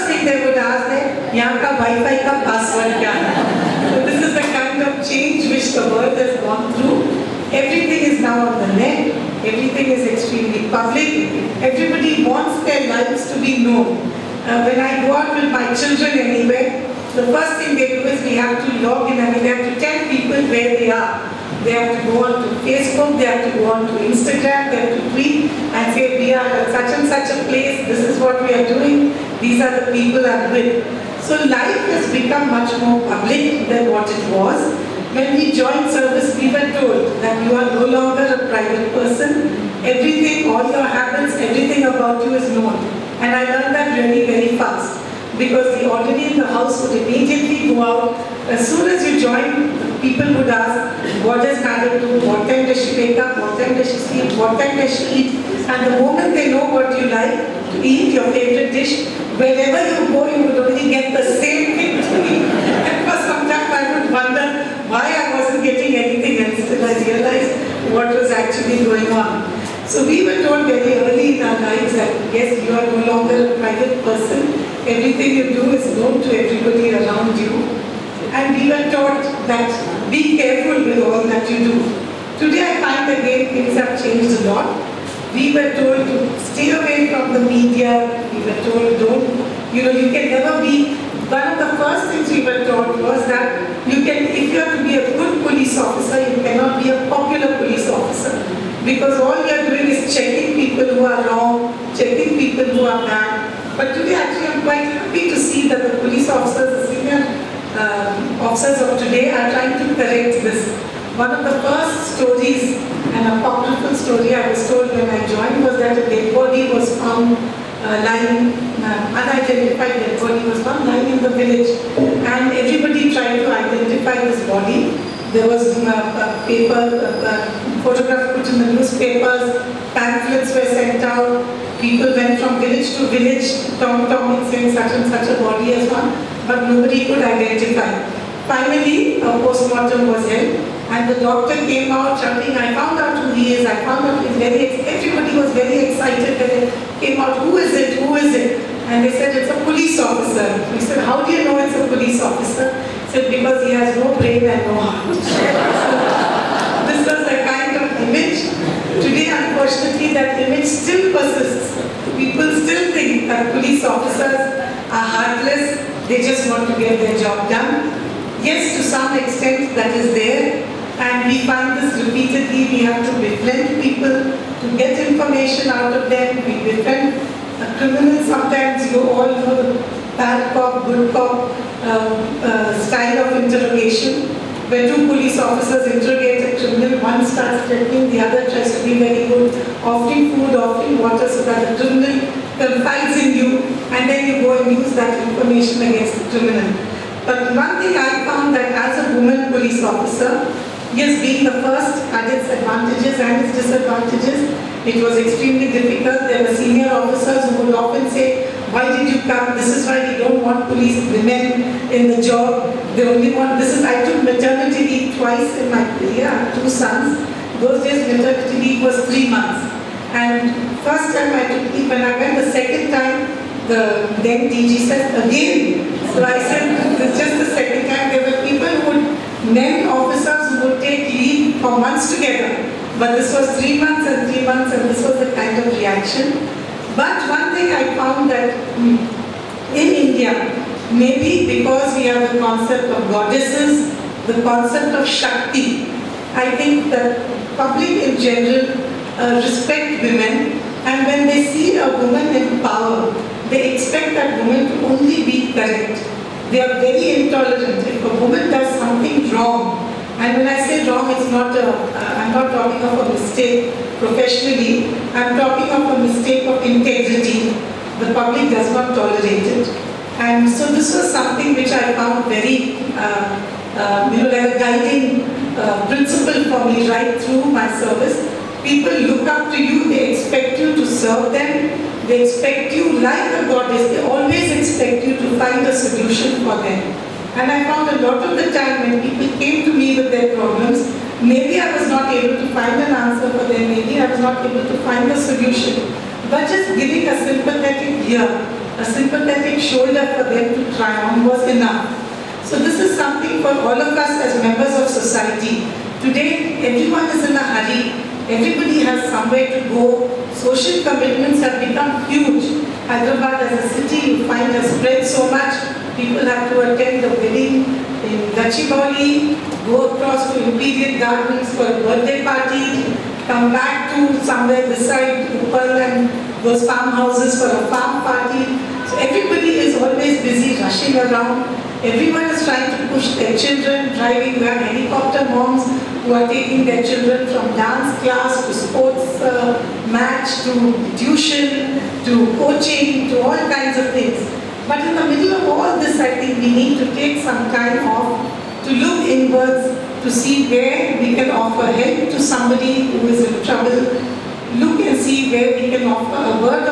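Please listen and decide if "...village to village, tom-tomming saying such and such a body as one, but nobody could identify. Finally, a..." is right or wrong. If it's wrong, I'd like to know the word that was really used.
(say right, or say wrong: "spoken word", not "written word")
right.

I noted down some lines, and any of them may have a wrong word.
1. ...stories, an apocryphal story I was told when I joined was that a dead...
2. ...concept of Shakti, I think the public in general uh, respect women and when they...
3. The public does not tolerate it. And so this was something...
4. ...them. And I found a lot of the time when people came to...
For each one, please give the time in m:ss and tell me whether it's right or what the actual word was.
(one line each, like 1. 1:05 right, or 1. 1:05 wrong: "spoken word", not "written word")
1. 1:52 right
2. 4:04 right
3. 4:28 right
4. 4:46 right.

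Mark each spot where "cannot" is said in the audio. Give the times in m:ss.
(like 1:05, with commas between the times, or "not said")
1:36.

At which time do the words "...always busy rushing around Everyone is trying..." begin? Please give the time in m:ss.
5:29.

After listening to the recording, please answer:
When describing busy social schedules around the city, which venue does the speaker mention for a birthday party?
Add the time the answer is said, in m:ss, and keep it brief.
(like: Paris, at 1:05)
Imperial Gardens, at 5:20.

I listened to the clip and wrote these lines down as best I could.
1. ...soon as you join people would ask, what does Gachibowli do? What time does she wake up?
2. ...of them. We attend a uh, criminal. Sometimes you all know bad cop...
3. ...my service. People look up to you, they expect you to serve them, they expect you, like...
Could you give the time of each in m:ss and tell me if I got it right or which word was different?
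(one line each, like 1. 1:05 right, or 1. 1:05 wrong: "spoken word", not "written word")
1. 0:48 wrong: "Kajal", not "Gachibowli"
2. 2:55 wrong: "befriend", not "attend"
3. 4:37 right.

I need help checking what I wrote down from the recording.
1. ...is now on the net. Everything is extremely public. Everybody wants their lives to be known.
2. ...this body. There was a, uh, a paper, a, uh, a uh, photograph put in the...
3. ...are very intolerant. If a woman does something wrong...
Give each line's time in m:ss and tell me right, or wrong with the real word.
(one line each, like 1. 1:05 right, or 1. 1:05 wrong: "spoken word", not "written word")
1. 0:08 right
2. 2:04 right
3. 4:16 right.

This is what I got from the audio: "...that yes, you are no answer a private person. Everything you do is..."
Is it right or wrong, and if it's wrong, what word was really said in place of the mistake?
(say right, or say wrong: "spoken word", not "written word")
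wrong: "longer", not "answer".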